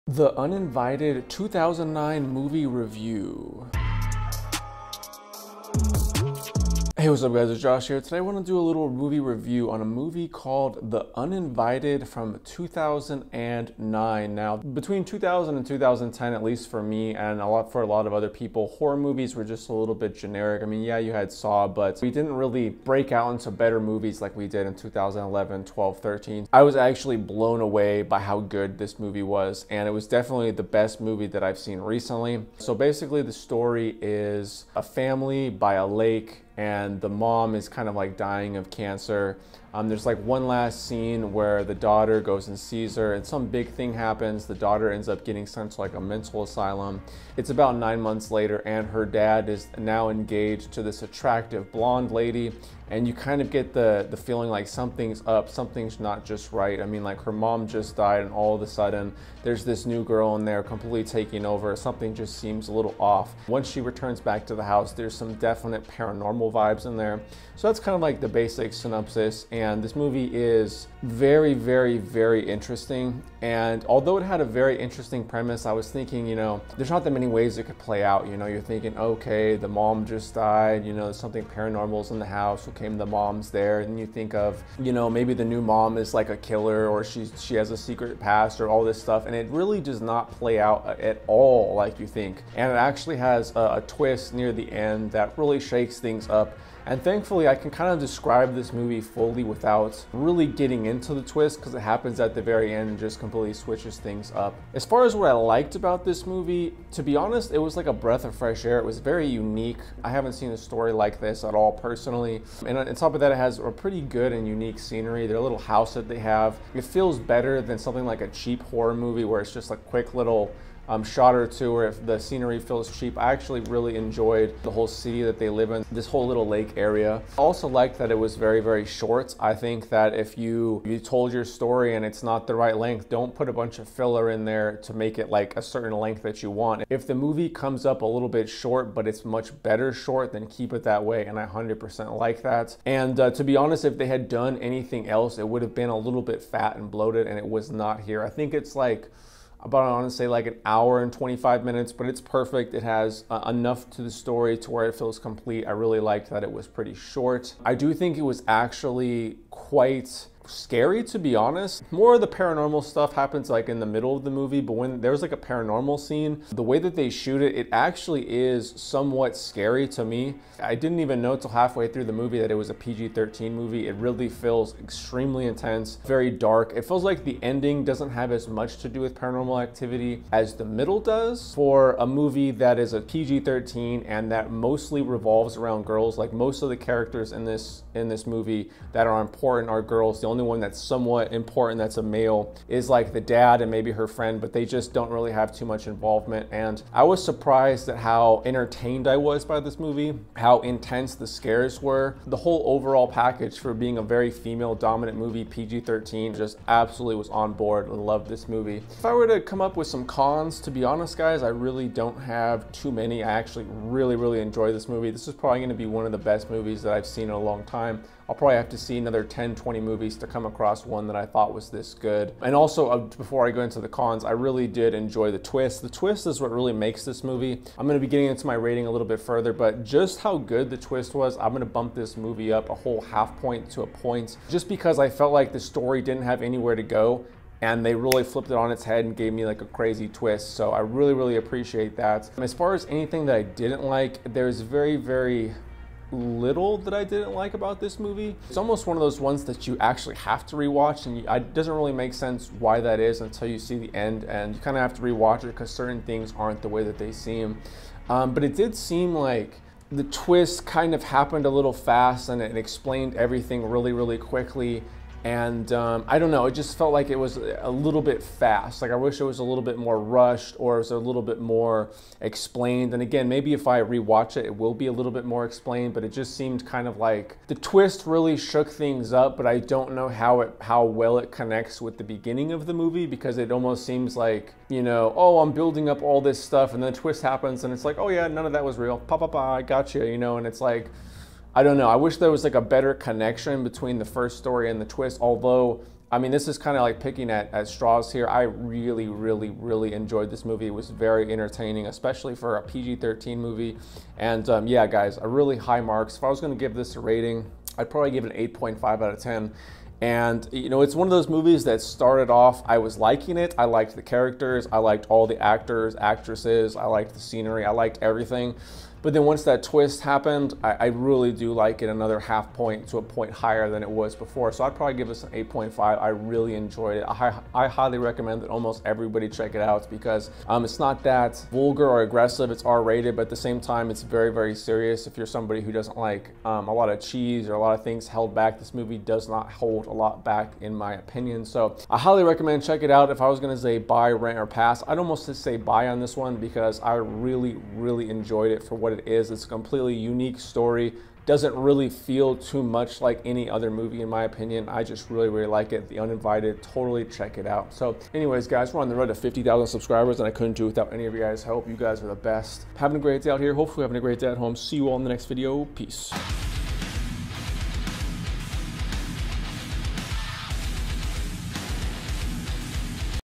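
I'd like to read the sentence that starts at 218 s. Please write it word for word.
I'll probably have to see another 10, 20 movies to come across one that I thought was this good.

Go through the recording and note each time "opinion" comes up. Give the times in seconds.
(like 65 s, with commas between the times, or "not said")
340 s, 354 s.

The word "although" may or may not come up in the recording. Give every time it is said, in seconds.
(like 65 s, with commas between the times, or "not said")
73 s, 295 s.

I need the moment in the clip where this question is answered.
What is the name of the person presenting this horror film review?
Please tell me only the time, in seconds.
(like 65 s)
7 s.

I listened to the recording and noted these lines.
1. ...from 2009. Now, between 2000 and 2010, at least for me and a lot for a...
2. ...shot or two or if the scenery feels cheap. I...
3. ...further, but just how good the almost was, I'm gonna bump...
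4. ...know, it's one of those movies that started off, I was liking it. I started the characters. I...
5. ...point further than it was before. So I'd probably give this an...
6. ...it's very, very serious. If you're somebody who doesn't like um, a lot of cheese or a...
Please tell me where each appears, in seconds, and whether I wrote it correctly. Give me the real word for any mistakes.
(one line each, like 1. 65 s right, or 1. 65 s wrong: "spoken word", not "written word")
1. 12 s right
2. 121 s right
3. 229 s wrong: "twist", not "almost"
4. 310 s wrong: "liked", not "started"
5. 323 s wrong: "higher", not "further"
6. 333 s right.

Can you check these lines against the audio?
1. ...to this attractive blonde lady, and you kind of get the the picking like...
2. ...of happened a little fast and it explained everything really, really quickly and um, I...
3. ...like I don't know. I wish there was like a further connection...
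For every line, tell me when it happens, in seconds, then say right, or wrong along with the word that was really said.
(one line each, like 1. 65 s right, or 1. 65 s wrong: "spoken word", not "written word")
1. 50 s wrong: "feeling", not "picking"
2. 260 s right
3. 290 s wrong: "better", not "further".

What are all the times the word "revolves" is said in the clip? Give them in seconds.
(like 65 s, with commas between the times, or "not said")
185 s.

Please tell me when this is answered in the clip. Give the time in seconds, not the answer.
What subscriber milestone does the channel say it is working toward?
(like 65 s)
359 s.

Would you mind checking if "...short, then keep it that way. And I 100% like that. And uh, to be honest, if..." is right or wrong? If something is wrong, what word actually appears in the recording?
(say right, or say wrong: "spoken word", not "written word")
right.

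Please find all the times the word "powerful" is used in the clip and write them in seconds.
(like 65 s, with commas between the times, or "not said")
not said.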